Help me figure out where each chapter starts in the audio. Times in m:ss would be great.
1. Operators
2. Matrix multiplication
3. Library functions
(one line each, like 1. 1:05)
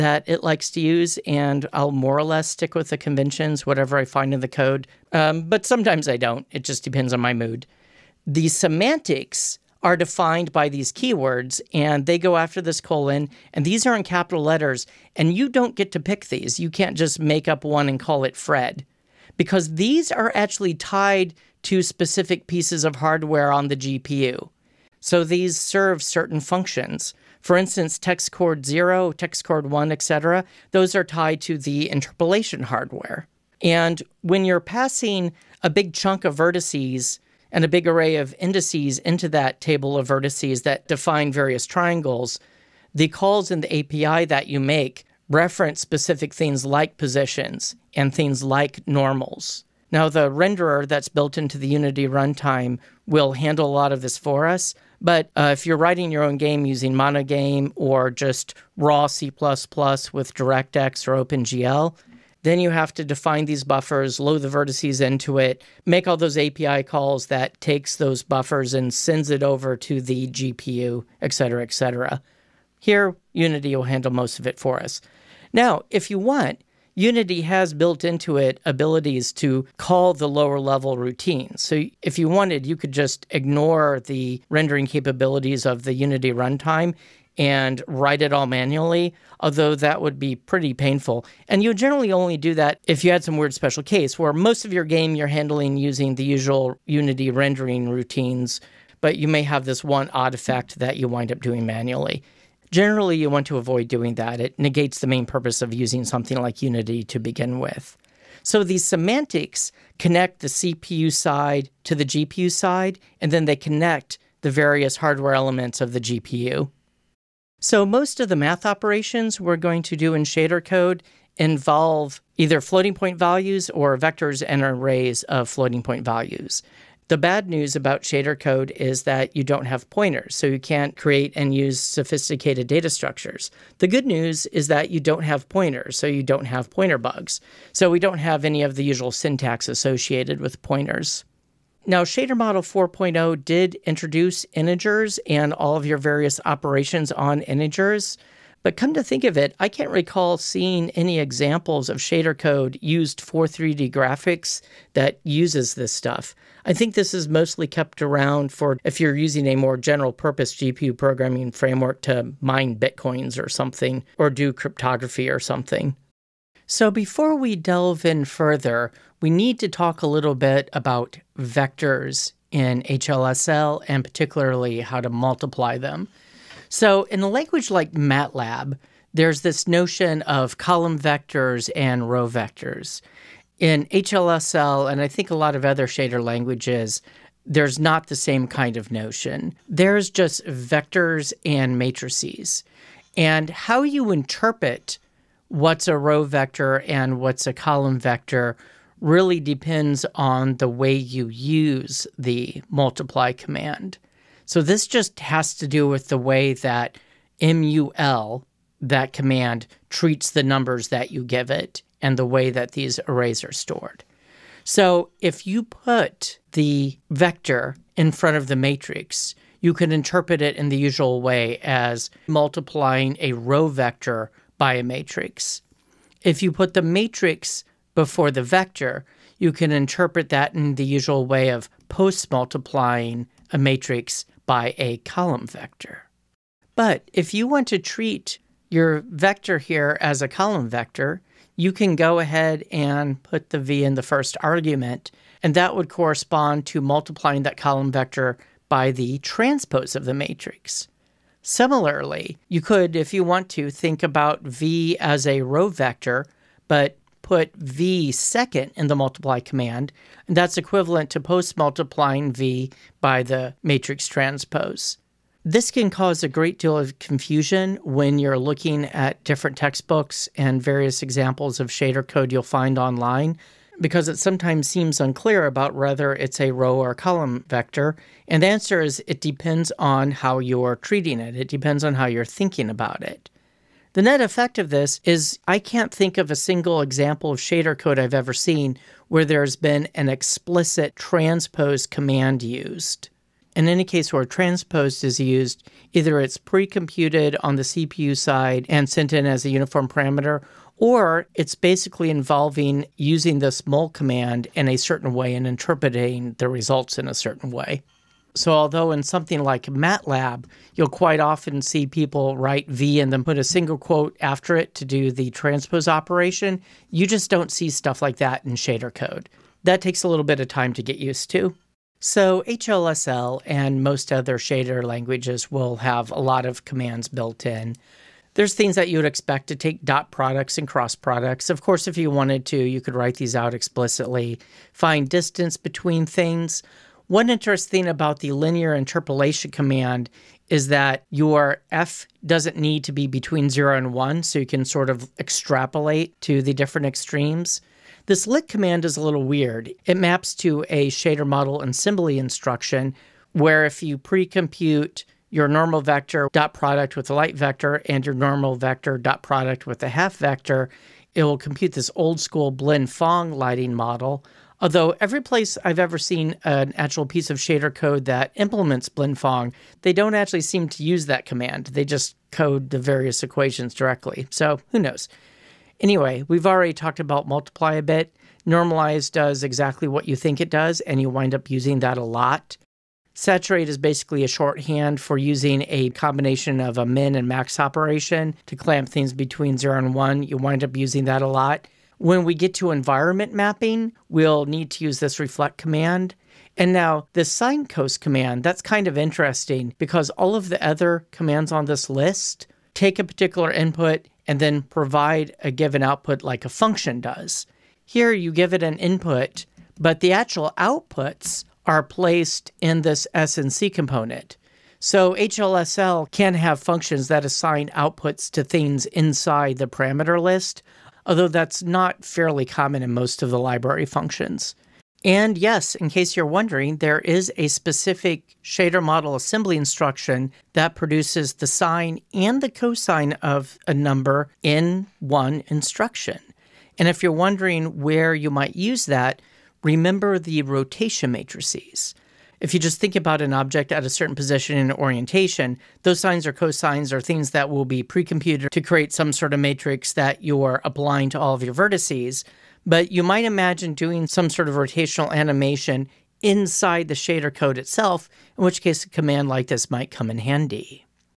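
1. 1:56
2. 2:45
3. 5:20.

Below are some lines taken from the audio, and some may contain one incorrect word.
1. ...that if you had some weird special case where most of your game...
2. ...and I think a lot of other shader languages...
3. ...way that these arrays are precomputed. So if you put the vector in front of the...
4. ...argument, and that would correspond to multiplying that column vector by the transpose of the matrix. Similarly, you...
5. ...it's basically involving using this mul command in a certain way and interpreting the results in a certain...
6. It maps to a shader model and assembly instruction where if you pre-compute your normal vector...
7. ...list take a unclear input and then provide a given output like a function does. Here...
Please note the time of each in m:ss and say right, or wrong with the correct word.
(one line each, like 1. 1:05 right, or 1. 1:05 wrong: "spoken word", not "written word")
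1. 1:32 right
2. 3:04 right
3. 3:32 wrong: "stored", not "precomputed"
4. 4:04 right
5. 5:01 right
6. 5:49 right
7. 6:41 wrong: "particular", not "unclear".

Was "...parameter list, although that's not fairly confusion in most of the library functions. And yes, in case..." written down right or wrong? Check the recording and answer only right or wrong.
wrong.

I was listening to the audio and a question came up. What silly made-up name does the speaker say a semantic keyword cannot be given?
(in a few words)
Fred.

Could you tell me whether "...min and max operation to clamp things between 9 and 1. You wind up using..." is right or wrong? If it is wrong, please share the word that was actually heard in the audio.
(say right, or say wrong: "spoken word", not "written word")
wrong: "0", not "9".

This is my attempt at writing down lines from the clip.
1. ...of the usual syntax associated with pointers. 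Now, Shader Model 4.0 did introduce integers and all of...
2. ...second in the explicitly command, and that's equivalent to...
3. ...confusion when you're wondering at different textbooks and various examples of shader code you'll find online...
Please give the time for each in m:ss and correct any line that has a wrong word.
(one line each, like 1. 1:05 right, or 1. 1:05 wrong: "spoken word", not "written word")
1. 2:18 right
2. 4:18 wrong: "multiply", not "explicitly"
3. 4:27 wrong: "looking", not "wondering".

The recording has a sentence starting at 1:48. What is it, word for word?
So these semantics connect the CPU side to the GPU side, and then they connect the various hardware elements of the GPU.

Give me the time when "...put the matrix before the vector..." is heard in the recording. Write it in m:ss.
3:46.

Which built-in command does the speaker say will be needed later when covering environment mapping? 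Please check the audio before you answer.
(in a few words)
reflect.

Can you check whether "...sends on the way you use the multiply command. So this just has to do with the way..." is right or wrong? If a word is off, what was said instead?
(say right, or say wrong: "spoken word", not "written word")
wrong: "depends", not "sends".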